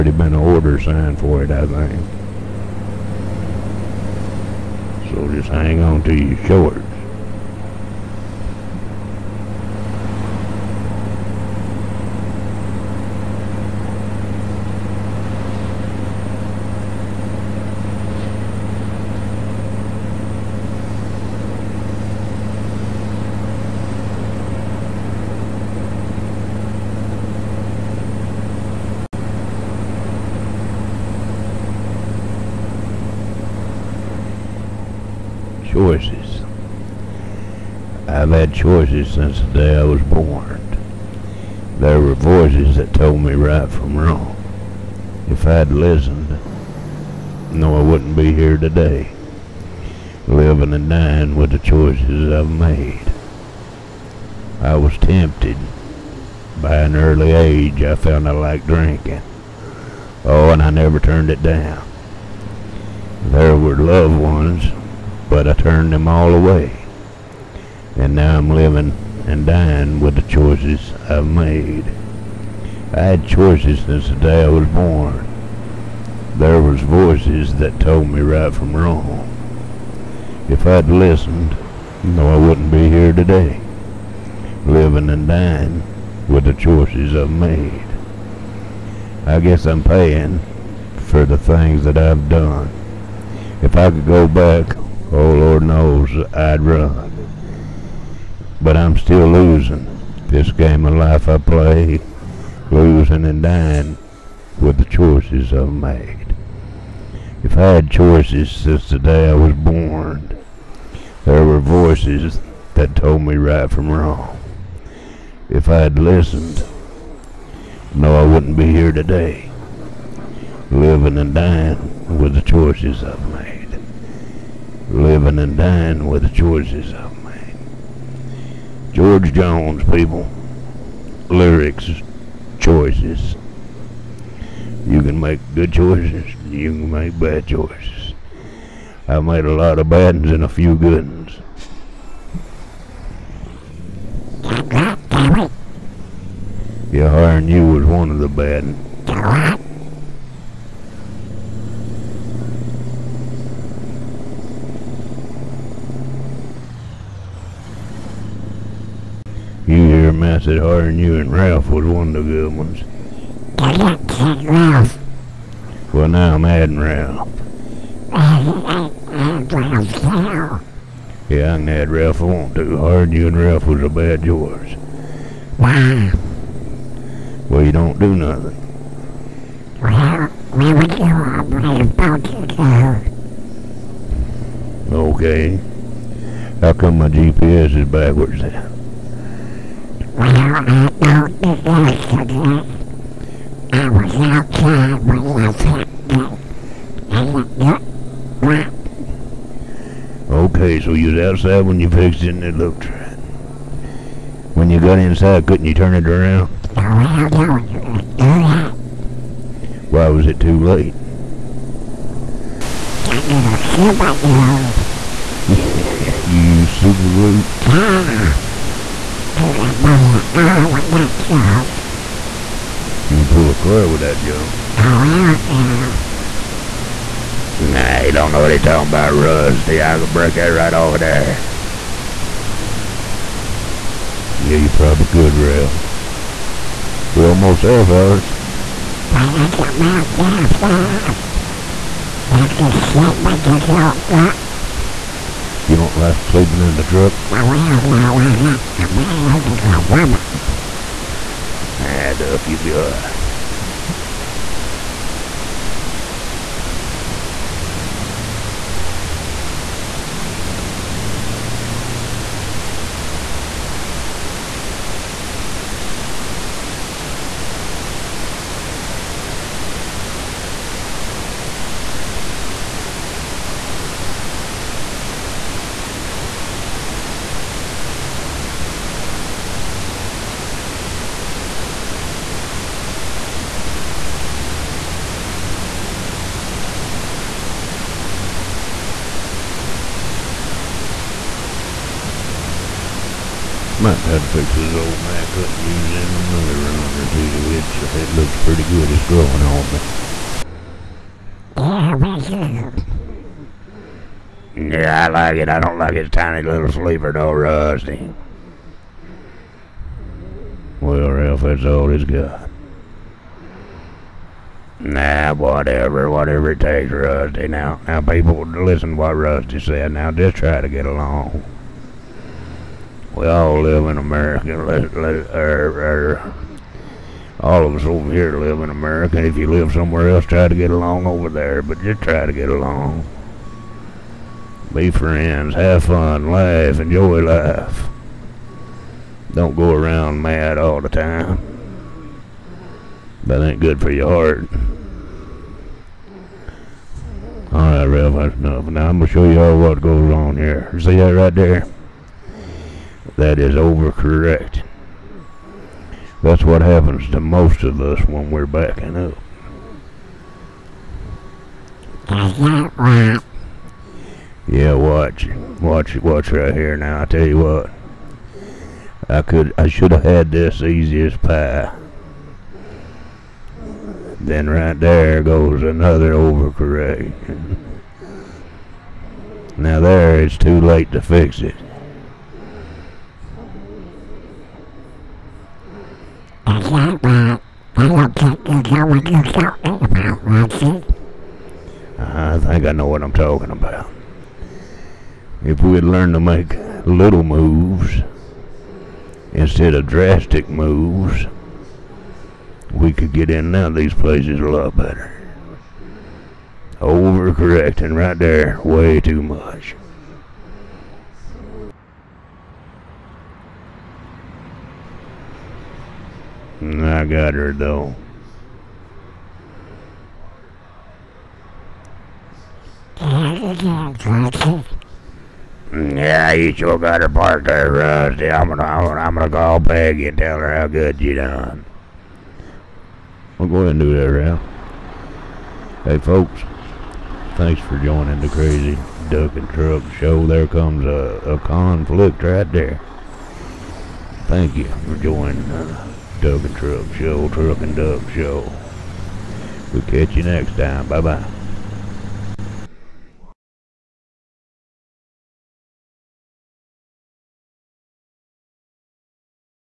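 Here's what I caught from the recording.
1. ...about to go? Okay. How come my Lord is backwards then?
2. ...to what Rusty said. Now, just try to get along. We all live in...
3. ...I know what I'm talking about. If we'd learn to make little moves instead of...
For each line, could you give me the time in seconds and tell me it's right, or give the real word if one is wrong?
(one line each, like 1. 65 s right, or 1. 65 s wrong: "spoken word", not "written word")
1. 181 s wrong: "GPS", not "Lord"
2. 318 s right
3. 392 s right.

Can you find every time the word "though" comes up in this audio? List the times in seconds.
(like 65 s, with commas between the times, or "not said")
307 s, 417 s.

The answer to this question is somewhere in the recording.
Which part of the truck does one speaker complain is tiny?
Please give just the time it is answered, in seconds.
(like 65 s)
306 s.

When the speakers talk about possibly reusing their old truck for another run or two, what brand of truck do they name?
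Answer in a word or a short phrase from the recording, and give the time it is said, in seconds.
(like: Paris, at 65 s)
Mack, at 295 s.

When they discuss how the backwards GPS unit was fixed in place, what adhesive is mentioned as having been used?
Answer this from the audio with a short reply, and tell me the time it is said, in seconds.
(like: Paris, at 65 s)
super glue, at 216 s.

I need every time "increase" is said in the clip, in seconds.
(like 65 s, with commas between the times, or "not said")
not said.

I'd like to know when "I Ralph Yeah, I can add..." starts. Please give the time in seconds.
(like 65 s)
168 s.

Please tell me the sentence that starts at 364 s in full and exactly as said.
Yeah, watch, watch, watch right here.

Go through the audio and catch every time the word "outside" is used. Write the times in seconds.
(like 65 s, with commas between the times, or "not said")
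191 s, 201 s.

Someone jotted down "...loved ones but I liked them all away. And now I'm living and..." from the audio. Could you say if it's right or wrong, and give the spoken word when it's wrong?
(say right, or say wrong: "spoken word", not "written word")
wrong: "turned", not "liked".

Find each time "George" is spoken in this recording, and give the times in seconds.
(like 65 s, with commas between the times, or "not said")
128 s.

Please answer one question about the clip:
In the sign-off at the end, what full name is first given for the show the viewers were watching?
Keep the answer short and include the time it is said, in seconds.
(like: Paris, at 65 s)
Crazy Duck and Truck Show, at 438 s.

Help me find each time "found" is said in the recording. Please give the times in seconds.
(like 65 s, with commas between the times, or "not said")
57 s, 192 s.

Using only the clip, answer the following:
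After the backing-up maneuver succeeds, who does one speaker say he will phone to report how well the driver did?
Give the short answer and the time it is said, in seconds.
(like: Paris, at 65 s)
Peggy, at 429 s.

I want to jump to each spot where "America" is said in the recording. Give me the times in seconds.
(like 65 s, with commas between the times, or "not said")
323 s, 328 s.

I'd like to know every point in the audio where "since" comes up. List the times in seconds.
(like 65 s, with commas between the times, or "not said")
39 s, 73 s, 108 s.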